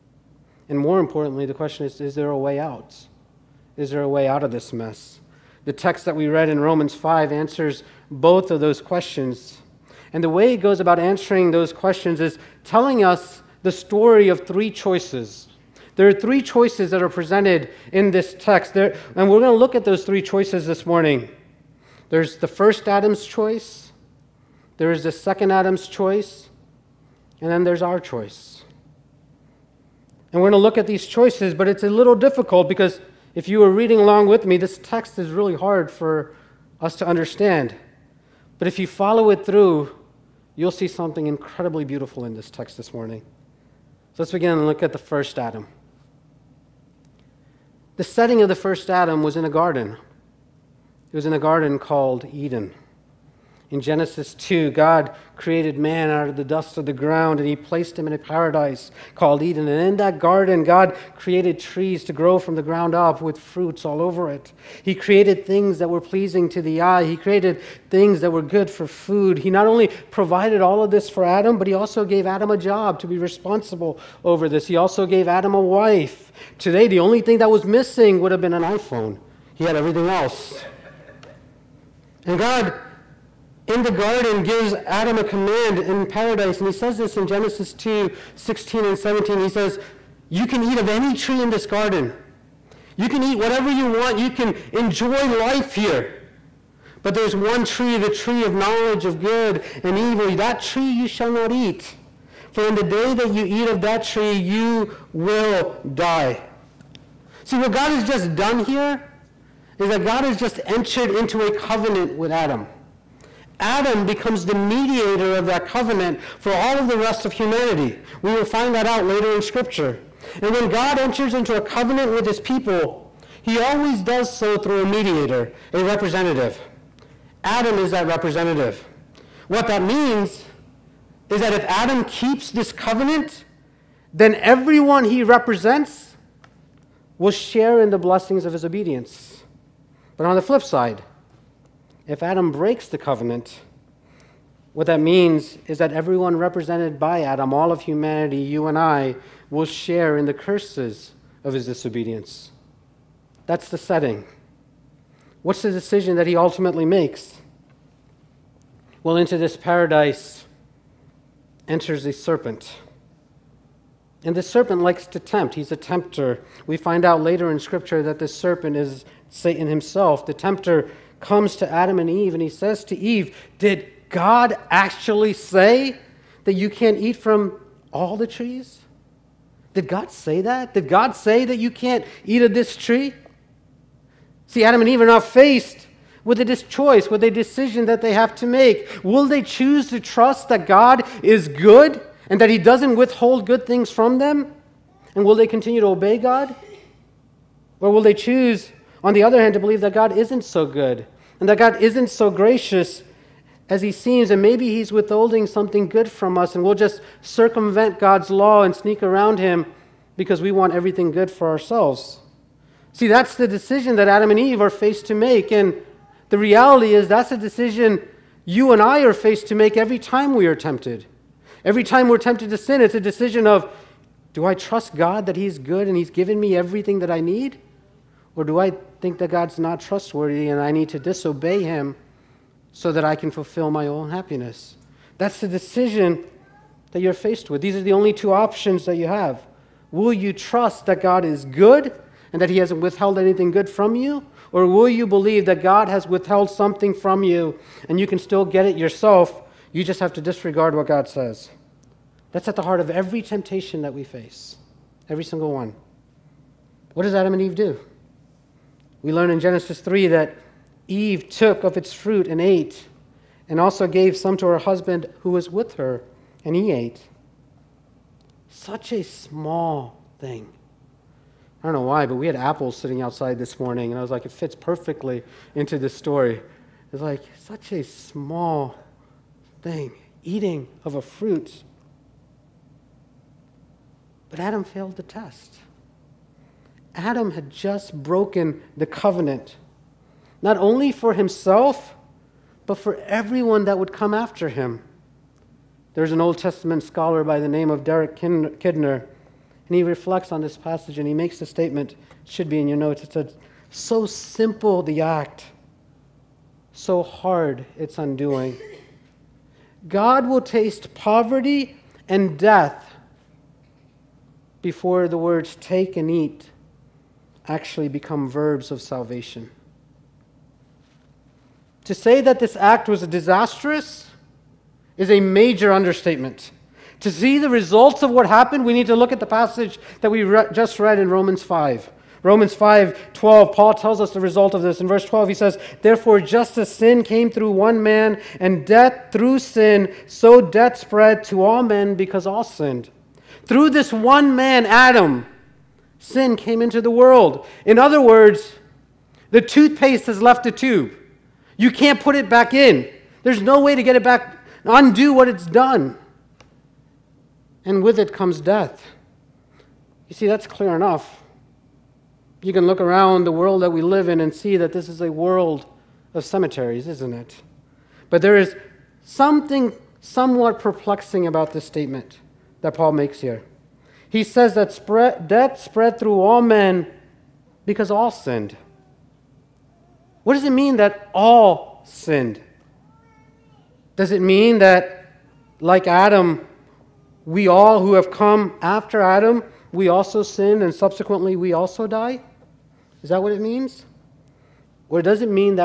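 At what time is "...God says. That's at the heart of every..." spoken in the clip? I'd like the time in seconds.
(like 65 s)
250 s.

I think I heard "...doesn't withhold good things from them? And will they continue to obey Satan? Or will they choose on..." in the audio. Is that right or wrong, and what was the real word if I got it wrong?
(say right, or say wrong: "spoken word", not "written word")
wrong: "God", not "Satan".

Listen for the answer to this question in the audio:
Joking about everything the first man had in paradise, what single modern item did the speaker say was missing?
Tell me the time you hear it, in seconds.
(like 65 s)
78 s.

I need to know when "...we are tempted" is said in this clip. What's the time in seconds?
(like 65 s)
220 s.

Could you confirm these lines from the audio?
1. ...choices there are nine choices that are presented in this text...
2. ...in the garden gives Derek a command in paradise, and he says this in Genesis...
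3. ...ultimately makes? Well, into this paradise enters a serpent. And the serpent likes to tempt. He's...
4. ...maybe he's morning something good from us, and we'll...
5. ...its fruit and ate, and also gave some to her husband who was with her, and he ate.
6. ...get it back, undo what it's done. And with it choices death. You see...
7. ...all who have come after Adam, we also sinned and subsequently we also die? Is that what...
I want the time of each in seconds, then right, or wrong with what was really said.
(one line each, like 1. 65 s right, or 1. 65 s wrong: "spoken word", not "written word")
1. 14 s wrong: "three", not "nine"
2. 83 s wrong: "Adam", not "Derek"
3. 156 s right
4. 204 s wrong: "withholding", not "morning"
5. 261 s right
6. 353 s wrong: "comes", not "choices"
7. 387 s right.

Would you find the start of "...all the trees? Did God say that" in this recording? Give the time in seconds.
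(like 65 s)
177 s.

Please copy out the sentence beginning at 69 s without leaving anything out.
He not only provided all of this for Adam, but he also gave Adam a job to be responsible over this.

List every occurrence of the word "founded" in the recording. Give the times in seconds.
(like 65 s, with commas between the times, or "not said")
not said.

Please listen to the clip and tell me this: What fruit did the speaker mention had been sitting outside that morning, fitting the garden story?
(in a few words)
Apples.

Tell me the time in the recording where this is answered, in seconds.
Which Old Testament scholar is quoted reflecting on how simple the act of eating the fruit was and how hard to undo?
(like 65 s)
297 s.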